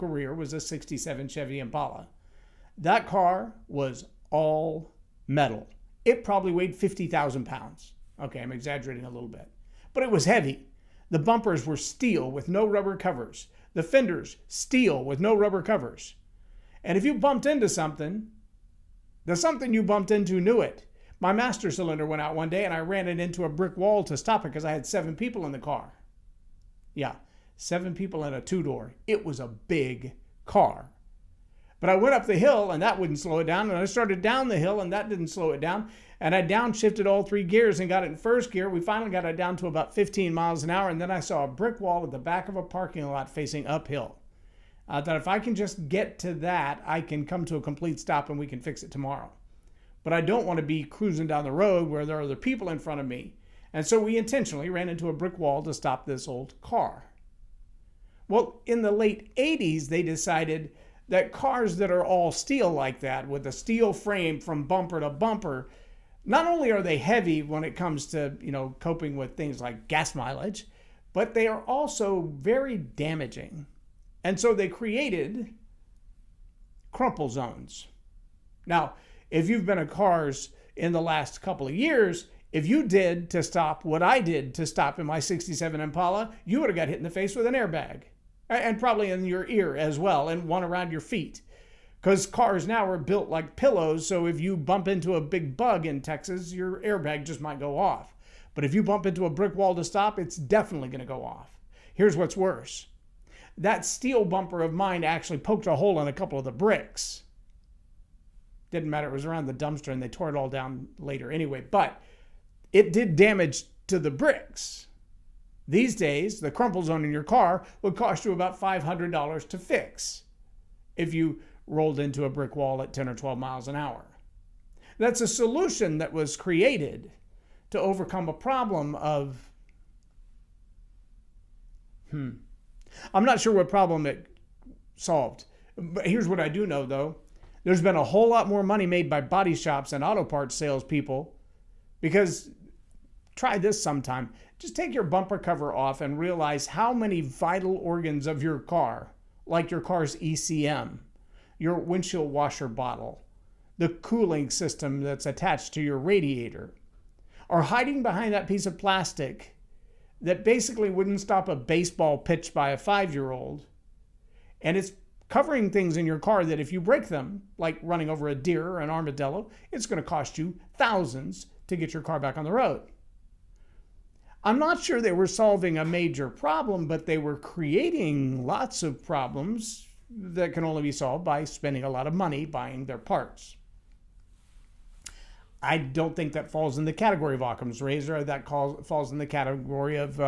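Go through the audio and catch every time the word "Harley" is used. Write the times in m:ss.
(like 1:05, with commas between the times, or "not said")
not said.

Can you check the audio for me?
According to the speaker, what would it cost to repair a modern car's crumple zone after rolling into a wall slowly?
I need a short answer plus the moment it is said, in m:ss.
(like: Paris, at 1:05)
$500, at 1:58.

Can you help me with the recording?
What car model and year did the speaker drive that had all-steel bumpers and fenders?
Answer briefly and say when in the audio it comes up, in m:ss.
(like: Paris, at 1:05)
67 Chevy Impala, at 0:00.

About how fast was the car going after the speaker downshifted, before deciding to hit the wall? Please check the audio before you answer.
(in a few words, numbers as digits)
15 miles an hour.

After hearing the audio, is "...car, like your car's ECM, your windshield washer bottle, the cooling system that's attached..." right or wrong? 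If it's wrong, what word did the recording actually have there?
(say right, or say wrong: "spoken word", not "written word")
right.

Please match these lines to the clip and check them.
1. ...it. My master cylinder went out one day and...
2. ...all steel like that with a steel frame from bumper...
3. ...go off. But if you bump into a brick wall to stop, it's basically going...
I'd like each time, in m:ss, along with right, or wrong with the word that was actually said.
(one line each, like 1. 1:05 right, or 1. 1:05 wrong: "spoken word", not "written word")
1. 0:20 right
2. 1:02 right
3. 1:37 wrong: "definitely", not "basically".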